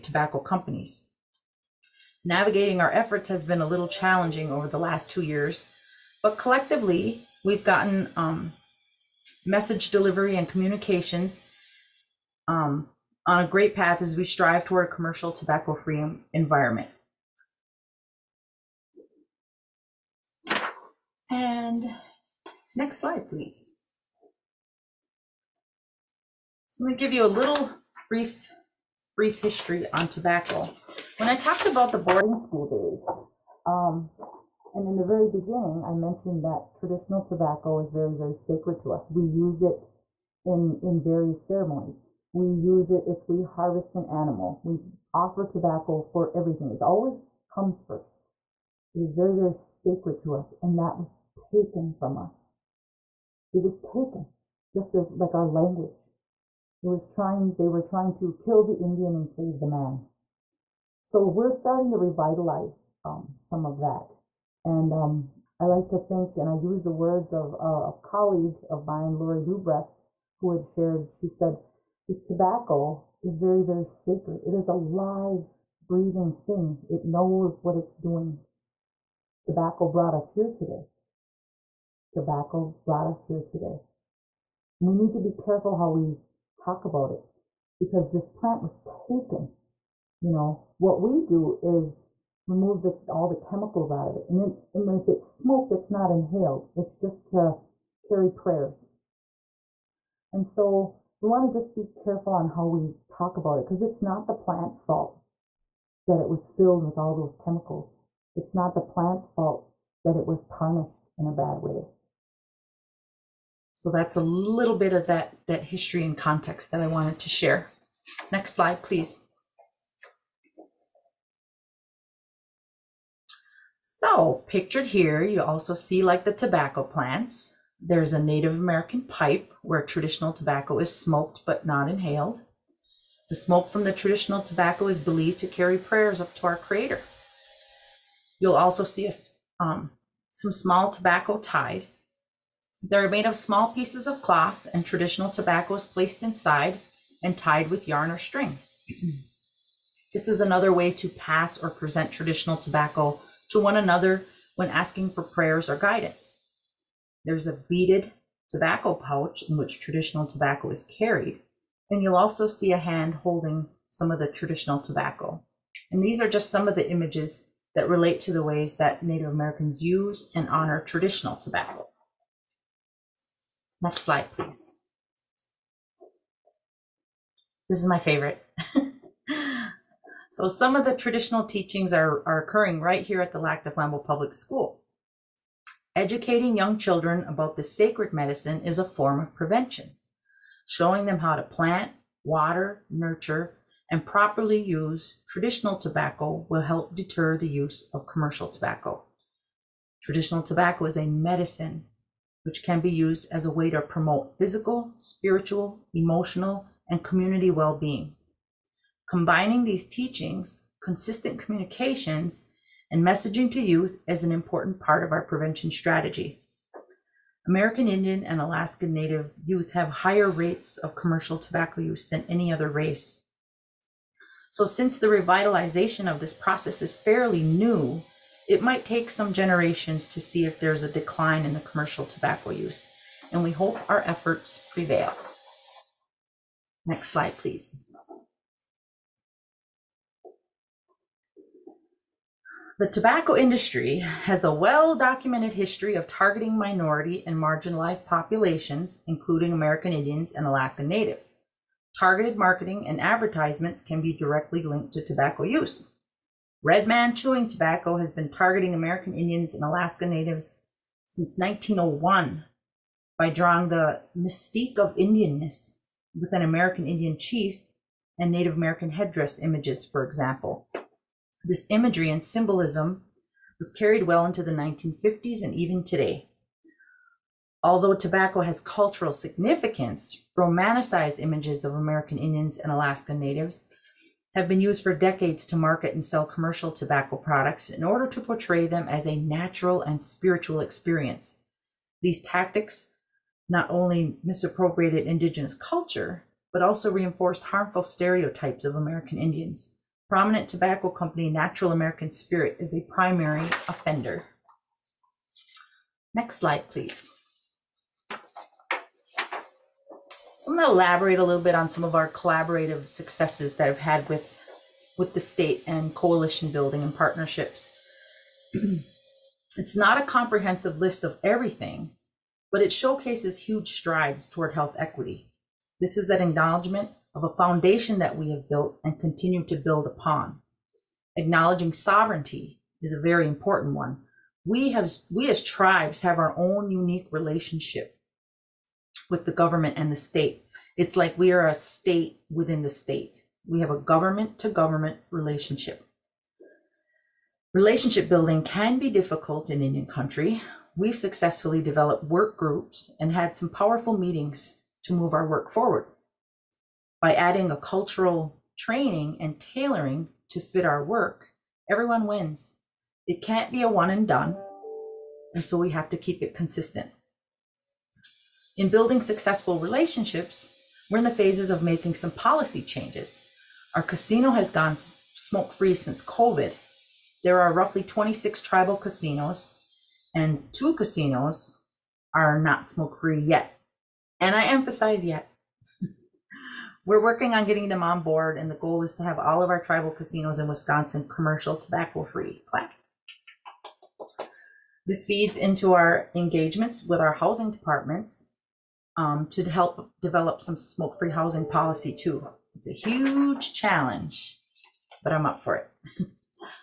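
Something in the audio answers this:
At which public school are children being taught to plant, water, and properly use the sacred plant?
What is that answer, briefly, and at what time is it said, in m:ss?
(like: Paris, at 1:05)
Lac du Flambeau Public School, at 3:03.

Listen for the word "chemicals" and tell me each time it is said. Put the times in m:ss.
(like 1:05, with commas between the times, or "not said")
1:33, 1:47.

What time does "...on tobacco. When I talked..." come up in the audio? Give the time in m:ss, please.
0:29.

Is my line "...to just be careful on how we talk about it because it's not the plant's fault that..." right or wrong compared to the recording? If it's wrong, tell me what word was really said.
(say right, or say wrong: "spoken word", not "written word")
right.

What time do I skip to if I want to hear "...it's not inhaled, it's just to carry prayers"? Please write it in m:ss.
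1:35.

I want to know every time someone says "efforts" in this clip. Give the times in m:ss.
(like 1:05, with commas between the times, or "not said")
0:02, 3:54.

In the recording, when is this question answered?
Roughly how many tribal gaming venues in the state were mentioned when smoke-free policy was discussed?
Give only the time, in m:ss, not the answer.
6:17.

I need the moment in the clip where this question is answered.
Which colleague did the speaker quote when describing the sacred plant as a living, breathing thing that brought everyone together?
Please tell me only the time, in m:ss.
1:09.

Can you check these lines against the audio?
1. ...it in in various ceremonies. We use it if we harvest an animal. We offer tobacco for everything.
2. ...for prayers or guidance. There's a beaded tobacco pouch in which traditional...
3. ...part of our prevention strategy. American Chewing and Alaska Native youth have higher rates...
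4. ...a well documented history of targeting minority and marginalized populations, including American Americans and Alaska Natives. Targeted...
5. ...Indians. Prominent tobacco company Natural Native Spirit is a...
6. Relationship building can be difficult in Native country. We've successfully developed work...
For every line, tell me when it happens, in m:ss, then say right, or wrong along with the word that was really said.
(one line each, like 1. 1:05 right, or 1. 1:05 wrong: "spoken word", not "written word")
1. 0:39 right
2. 2:35 right
3. 3:34 wrong: "Indian", not "Chewing"
4. 4:04 wrong: "Indians", not "Americans"
5. 4:59 wrong: "American", not "Native"
6. 5:47 wrong: "Indian", not "Native".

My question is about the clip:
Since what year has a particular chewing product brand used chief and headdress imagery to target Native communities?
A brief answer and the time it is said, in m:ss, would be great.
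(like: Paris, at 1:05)
1901, at 4:21.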